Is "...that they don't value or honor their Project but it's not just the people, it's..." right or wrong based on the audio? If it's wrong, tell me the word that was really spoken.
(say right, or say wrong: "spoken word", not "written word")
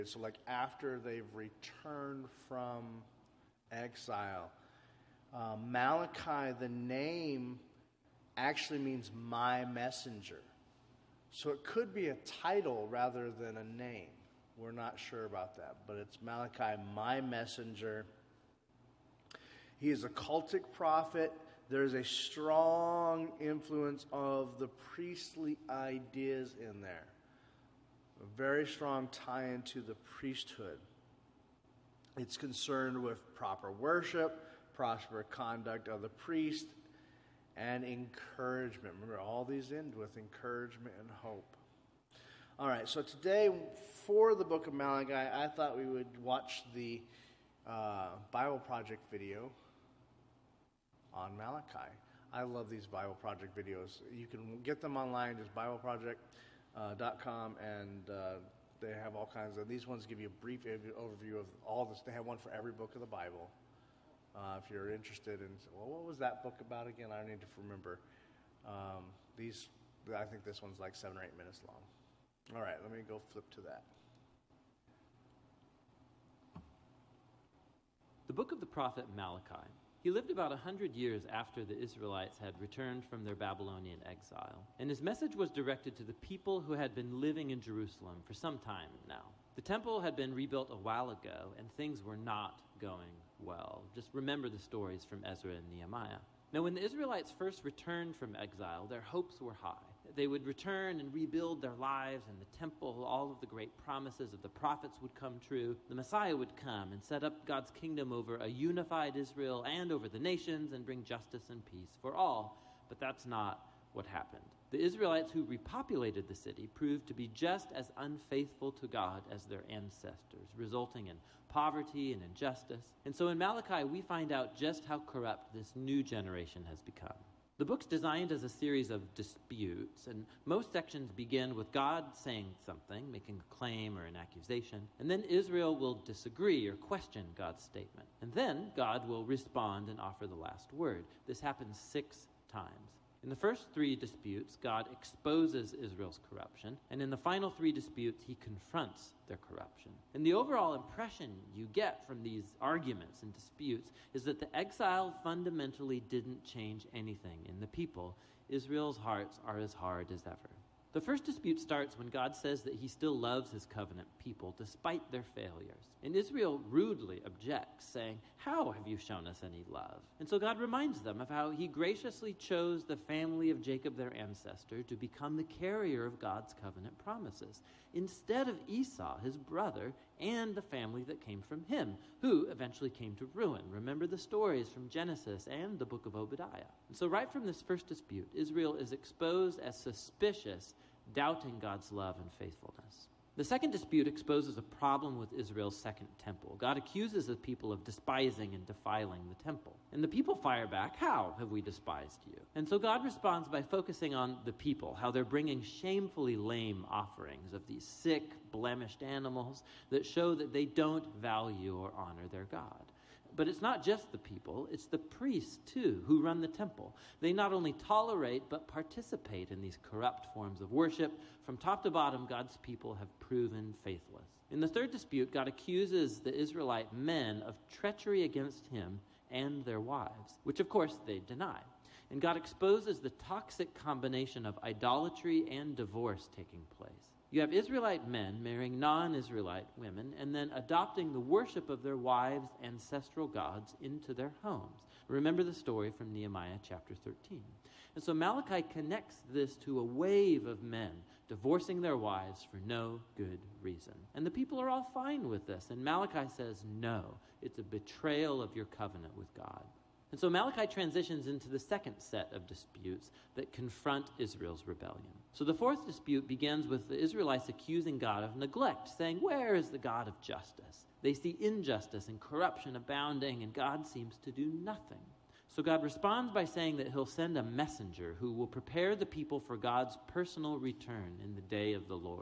wrong: "God", not "Project".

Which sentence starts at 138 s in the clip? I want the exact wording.
And then God will respond and offer the last word.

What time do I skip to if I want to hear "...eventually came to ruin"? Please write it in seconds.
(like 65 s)
182 s.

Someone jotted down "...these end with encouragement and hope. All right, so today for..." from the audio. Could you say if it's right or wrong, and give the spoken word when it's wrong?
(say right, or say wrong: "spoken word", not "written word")
right.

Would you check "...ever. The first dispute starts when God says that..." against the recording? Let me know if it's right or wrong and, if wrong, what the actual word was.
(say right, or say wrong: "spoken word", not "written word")
right.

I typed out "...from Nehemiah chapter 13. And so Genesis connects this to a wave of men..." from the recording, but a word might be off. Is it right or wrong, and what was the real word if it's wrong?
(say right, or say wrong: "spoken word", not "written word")
wrong: "Malachi", not "Genesis".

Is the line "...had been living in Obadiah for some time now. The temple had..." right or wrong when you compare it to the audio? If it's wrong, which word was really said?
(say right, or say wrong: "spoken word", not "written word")
wrong: "Jerusalem", not "Obadiah".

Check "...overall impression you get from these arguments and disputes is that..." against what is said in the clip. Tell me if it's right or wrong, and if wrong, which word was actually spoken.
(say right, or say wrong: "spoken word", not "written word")
right.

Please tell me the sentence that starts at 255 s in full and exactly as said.
And Malachi says, no, it's a betrayal of your covenant with God.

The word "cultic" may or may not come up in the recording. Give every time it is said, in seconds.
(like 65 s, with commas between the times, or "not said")
20 s.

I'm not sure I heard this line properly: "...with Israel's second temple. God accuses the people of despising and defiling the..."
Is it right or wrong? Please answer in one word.
right.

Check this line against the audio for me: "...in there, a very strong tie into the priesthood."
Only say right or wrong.
right.